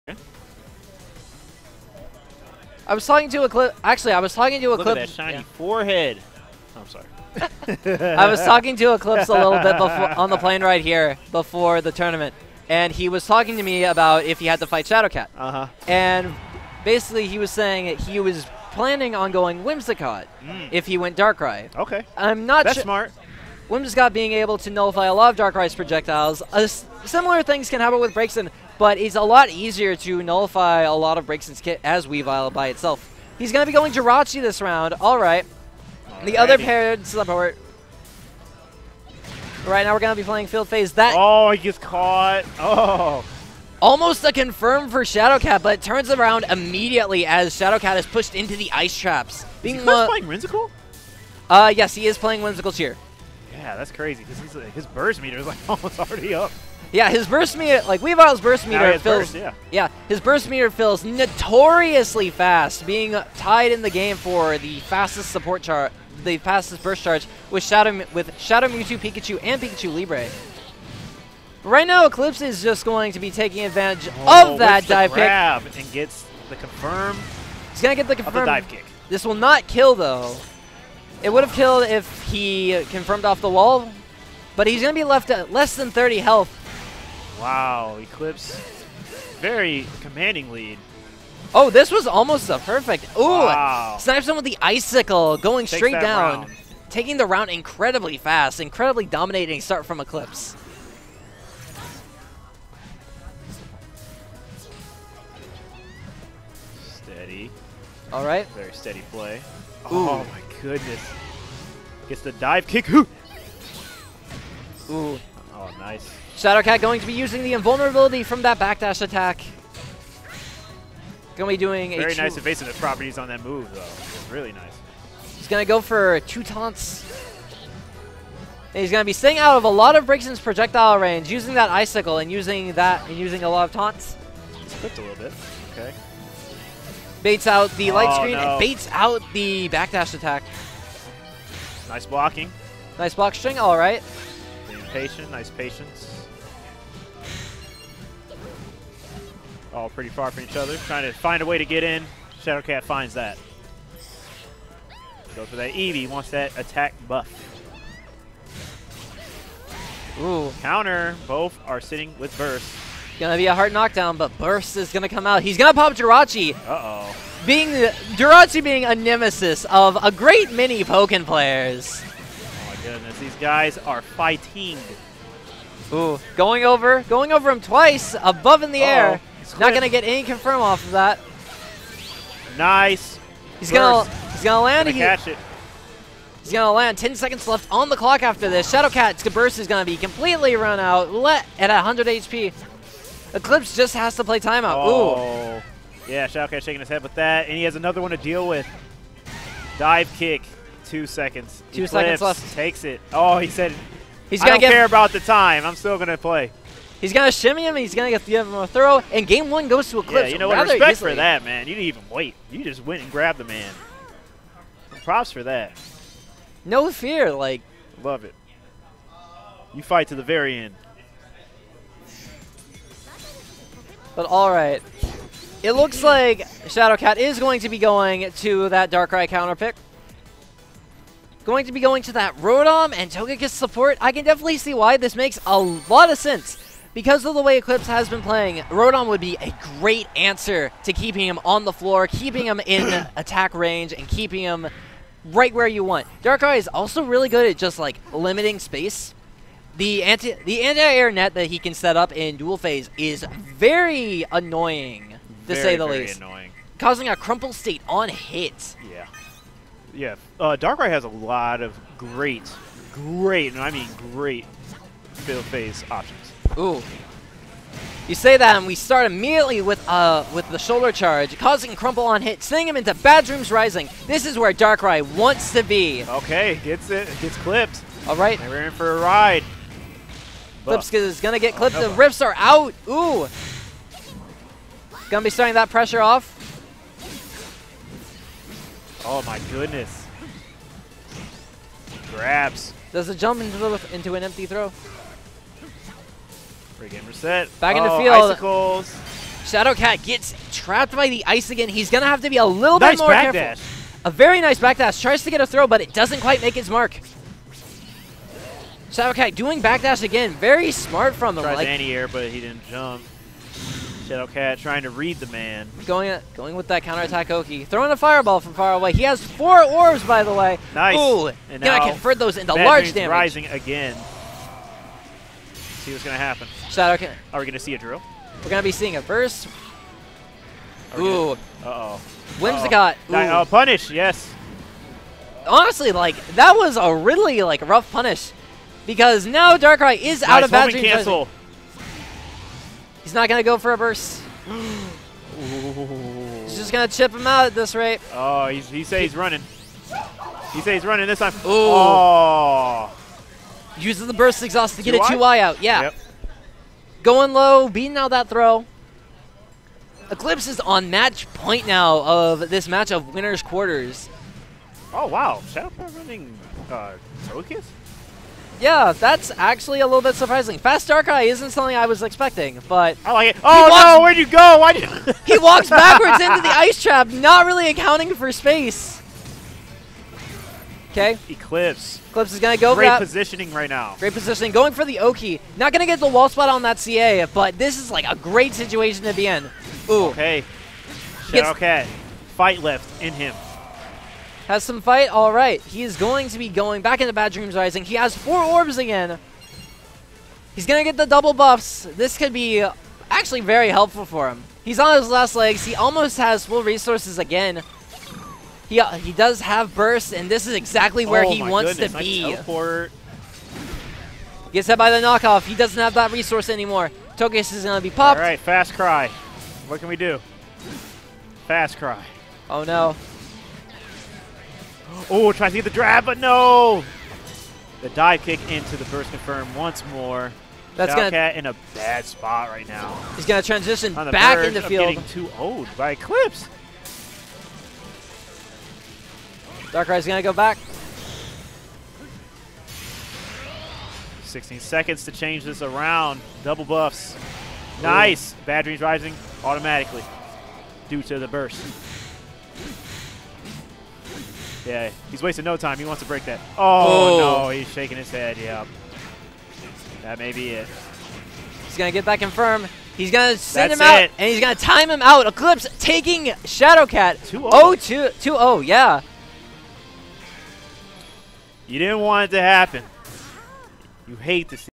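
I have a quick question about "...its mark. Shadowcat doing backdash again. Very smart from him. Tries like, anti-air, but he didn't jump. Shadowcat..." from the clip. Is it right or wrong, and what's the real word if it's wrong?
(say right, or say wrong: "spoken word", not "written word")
right.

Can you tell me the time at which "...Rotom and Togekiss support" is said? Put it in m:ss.
3:52.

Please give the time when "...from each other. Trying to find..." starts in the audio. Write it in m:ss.
2:30.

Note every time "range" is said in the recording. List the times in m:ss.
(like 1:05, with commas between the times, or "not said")
2:10, 4:03.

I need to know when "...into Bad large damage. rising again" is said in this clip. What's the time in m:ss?
5:22.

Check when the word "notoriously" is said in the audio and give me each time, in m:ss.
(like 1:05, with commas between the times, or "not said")
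1:01.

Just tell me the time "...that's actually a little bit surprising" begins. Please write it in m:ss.
6:08.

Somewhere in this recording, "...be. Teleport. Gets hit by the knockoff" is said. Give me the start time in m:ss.
6:51.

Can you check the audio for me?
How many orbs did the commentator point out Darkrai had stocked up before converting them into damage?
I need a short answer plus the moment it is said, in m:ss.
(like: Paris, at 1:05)
4, at 5:18.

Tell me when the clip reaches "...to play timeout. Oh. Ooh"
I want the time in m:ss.
3:14.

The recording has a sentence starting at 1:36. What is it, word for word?
taking the round incredibly fast, incredibly dominating start from Eclipse.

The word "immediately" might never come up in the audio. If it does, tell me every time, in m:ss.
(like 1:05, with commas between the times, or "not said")
0:46, 4:29.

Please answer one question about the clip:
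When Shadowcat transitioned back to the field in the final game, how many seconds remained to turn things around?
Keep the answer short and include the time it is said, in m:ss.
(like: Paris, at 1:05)
16, at 7:24.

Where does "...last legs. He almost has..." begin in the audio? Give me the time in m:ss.
6:45.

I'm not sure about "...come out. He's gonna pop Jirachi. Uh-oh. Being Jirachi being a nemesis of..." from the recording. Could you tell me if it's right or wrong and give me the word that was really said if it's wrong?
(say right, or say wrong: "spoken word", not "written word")
right.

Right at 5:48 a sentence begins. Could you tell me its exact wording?
Oh, he's, he says he's running.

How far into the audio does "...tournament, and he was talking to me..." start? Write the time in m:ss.
0:11.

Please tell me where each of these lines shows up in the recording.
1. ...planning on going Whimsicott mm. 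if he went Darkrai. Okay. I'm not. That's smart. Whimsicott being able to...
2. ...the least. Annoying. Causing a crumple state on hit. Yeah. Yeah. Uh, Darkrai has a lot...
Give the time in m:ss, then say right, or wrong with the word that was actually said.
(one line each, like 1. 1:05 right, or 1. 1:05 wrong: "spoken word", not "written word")
1. 0:18 right
2. 4:15 right.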